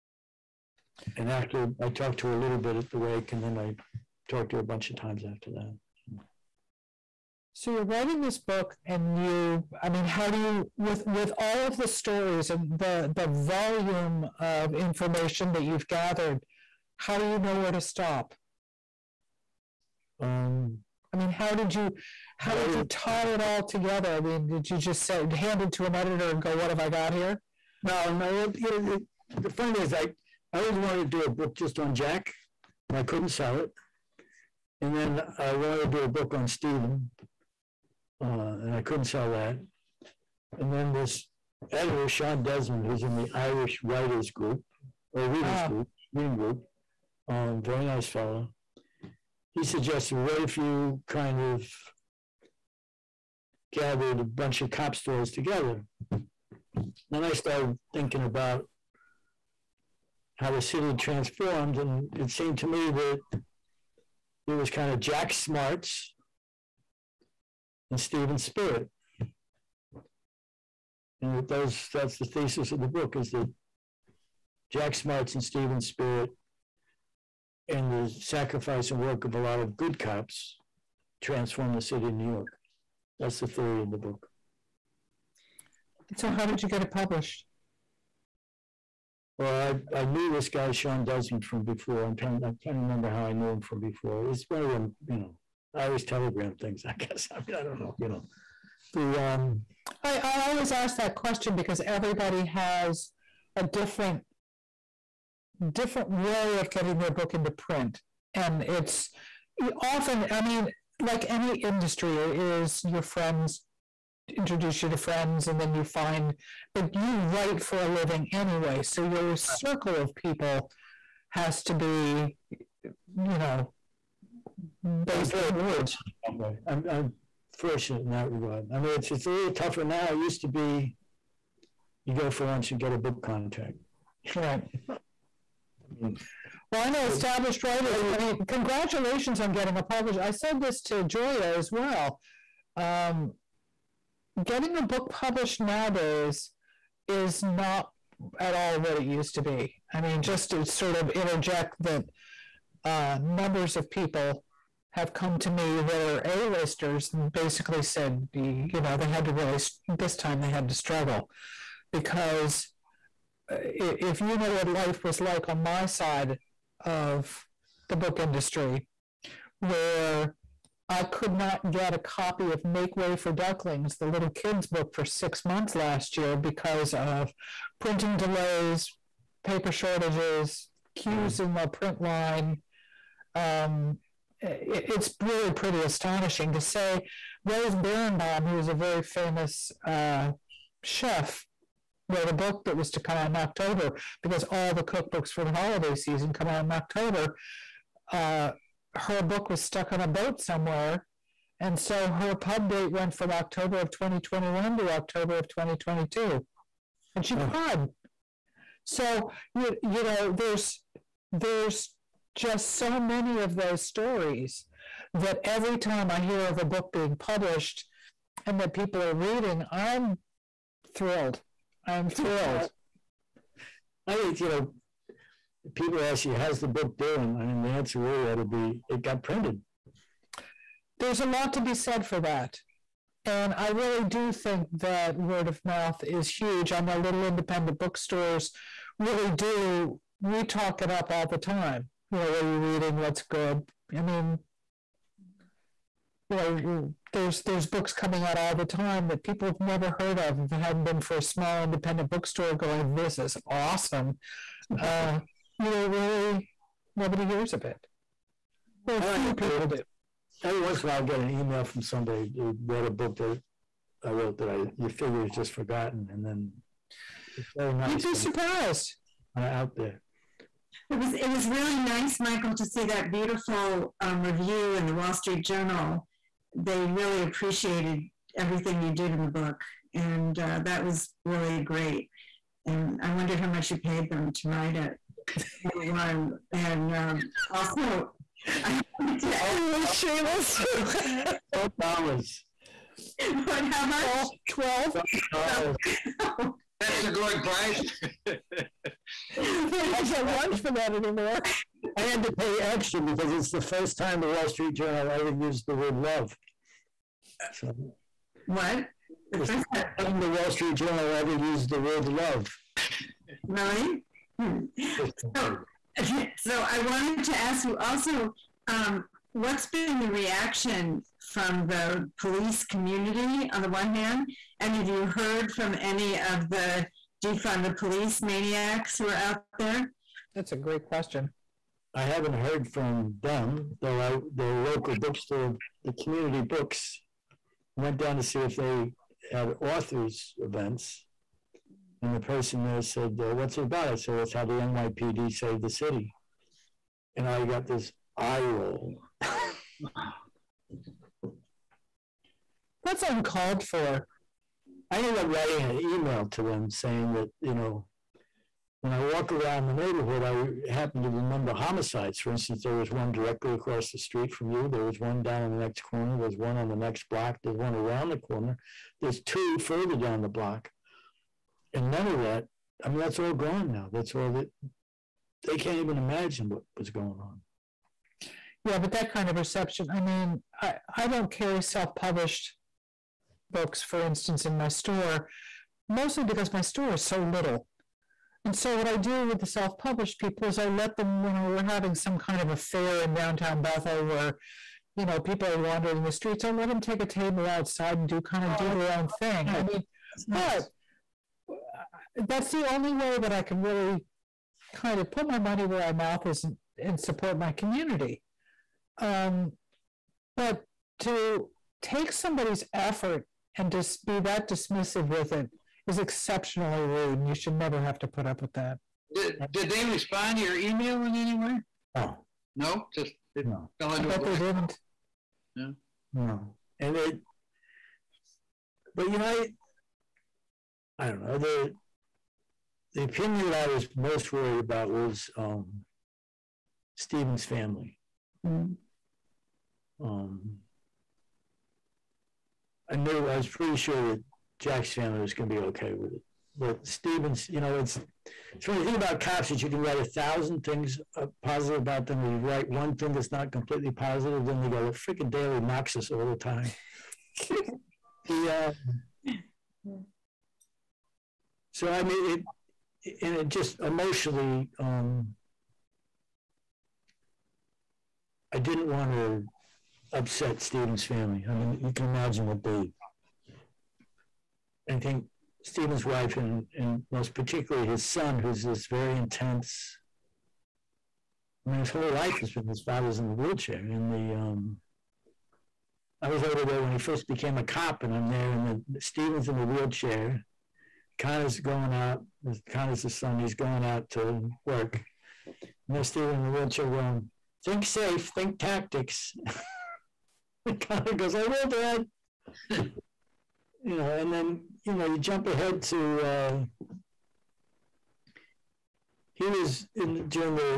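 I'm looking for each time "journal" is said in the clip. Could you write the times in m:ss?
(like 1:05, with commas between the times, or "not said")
4:35, 5:04, 5:10.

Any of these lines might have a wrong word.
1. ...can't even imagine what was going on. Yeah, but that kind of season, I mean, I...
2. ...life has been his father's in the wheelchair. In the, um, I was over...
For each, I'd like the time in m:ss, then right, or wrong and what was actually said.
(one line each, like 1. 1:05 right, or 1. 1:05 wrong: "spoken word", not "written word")
1. 6:15 wrong: "reception", not "season"
2. 8:02 right.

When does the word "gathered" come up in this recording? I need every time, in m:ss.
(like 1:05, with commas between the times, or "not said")
0:15, 0:53.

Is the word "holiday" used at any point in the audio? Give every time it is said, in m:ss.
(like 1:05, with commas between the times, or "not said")
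3:15.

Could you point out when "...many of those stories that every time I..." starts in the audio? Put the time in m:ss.
3:33.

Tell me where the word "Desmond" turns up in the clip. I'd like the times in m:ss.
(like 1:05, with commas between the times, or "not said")
0:42, 1:31.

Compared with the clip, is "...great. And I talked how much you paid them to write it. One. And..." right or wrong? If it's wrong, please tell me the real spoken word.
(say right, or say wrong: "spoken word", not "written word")
wrong: "wondered", not "talked".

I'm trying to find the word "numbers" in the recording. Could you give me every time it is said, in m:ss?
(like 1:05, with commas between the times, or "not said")
2:33.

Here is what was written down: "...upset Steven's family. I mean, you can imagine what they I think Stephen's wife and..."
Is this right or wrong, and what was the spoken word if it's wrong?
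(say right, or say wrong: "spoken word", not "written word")
right.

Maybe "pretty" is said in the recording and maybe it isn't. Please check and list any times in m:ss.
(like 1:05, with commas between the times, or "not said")
3:05, 7:23.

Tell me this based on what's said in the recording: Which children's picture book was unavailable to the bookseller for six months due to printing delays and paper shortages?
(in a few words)
Make Way for Ducklings.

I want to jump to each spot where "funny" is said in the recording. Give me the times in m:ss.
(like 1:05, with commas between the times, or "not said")
0:29, 7:28.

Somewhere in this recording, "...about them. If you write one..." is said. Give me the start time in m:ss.
7:31.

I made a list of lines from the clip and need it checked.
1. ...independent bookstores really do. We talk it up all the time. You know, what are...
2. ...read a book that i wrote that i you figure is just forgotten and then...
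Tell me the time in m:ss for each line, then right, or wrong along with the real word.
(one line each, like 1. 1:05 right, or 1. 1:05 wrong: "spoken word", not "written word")
1. 3:57 right
2. 4:22 right.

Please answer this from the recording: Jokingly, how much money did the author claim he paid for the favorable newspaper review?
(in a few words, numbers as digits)
$12.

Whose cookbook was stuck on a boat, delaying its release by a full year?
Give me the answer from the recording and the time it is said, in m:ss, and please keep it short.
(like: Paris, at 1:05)
Rose Beranbaum, at 3:07.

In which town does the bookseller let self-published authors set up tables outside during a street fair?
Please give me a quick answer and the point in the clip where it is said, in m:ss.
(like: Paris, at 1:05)
Bethel, at 6:33.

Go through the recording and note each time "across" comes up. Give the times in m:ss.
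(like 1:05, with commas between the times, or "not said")
6:03.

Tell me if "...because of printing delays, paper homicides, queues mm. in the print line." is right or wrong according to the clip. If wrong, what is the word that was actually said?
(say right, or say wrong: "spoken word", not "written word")
wrong: "shortages", not "homicides".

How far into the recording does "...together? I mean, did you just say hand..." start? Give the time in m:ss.
0:23.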